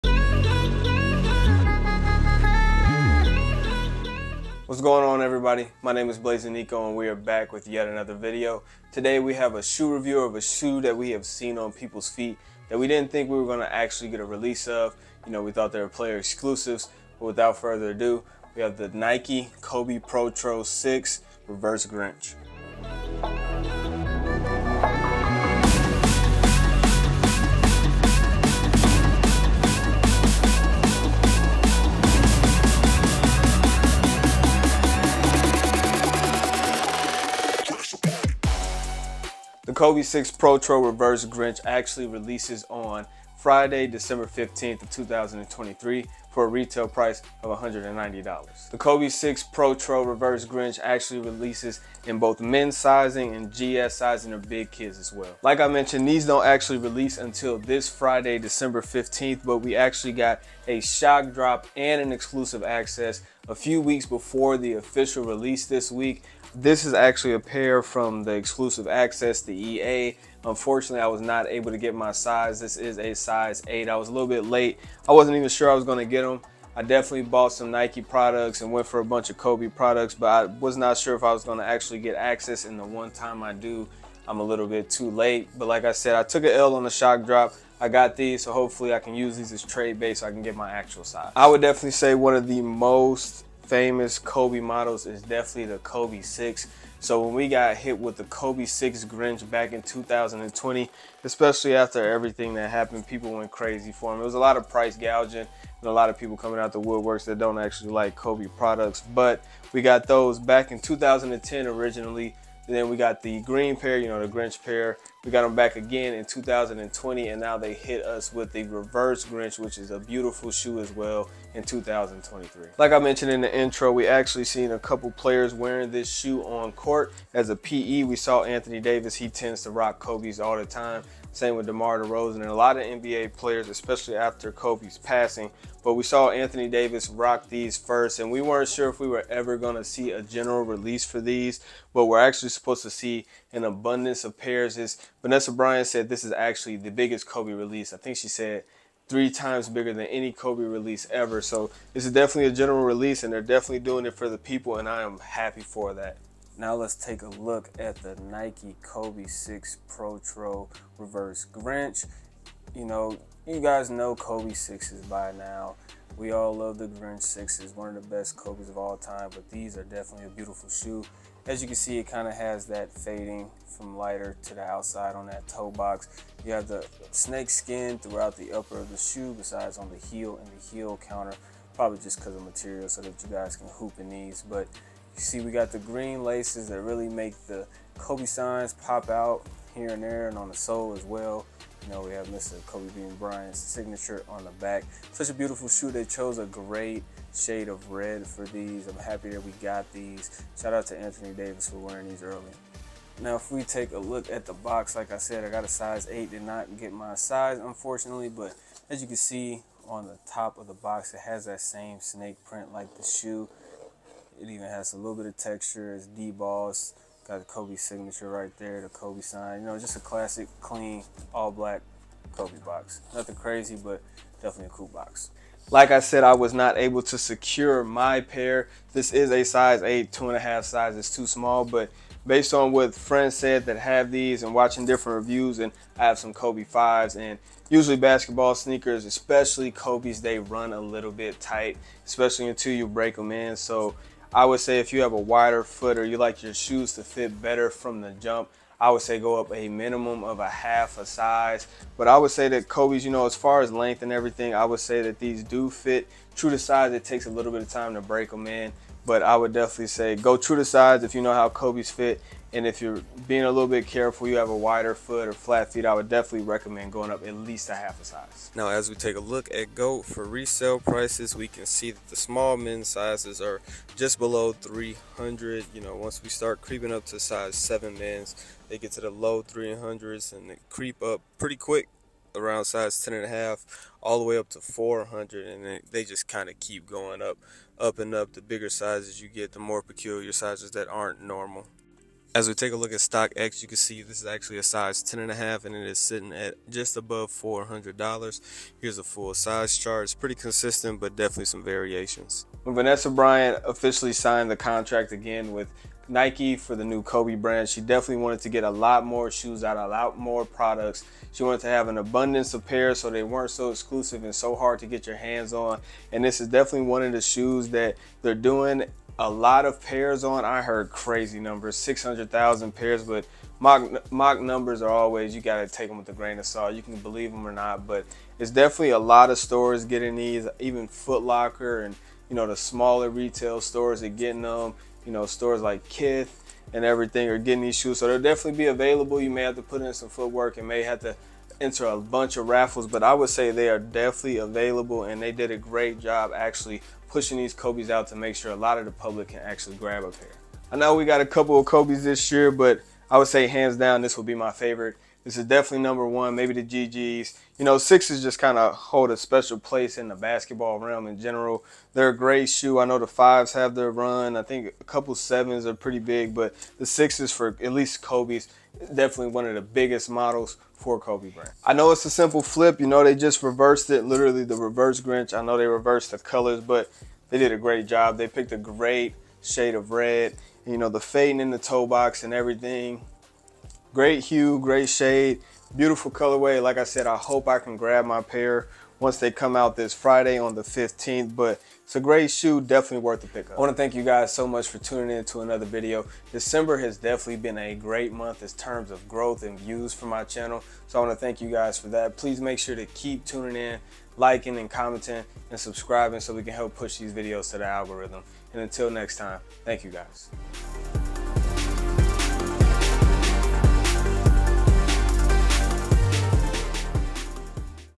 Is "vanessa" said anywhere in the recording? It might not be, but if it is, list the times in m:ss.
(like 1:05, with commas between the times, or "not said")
2:25, 5:02.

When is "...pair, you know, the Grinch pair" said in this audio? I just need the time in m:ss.
1:53.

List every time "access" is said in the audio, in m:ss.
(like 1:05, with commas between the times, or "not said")
1:02, 1:08, 1:22.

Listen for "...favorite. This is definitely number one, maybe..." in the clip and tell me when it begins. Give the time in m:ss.
5:54.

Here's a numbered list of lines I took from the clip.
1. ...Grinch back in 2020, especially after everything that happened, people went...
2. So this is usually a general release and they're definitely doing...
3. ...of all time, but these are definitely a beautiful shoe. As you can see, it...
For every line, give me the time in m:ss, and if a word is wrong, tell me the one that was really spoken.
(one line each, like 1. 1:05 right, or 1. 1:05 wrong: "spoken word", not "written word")
1. 1:39 right
2. 2:31 wrong: "definitely", not "usually"
3. 2:48 right.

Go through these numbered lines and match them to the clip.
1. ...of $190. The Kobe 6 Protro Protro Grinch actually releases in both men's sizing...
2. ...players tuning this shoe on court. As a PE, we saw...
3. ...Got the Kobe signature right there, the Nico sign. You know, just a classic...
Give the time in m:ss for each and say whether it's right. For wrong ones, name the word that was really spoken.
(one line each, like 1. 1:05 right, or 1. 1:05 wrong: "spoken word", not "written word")
1. 0:47 wrong: "Reverse", not "Protro"
2. 2:05 wrong: "wearing", not "tuning"
3. 3:37 wrong: "Kobe", not "Nico".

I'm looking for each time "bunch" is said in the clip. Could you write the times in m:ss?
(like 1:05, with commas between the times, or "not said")
1:19, 5:41.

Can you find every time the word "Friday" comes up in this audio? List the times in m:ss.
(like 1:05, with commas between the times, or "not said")
0:43, 0:57, 6:29.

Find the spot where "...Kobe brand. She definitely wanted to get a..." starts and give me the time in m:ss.
5:07.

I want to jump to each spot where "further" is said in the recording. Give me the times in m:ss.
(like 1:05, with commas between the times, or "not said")
0:17.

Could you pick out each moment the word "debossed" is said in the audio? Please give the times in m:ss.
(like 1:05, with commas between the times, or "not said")
3:36.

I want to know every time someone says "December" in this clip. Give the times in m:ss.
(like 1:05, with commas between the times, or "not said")
0:43, 0:58, 6:36.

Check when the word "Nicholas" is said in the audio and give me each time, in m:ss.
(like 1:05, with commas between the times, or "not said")
not said.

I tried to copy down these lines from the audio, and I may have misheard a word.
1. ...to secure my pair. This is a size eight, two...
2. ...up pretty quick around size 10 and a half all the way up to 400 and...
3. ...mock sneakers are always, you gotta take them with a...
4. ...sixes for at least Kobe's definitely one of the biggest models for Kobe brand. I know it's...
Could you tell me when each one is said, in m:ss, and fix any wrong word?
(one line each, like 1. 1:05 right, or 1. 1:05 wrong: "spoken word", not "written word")
1. 3:47 right
2. 4:41 right
3. 5:24 wrong: "numbers", not "sneakers"
4. 6:06 right.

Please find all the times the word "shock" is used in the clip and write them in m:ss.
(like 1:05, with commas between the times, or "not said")
1:00, 1:26.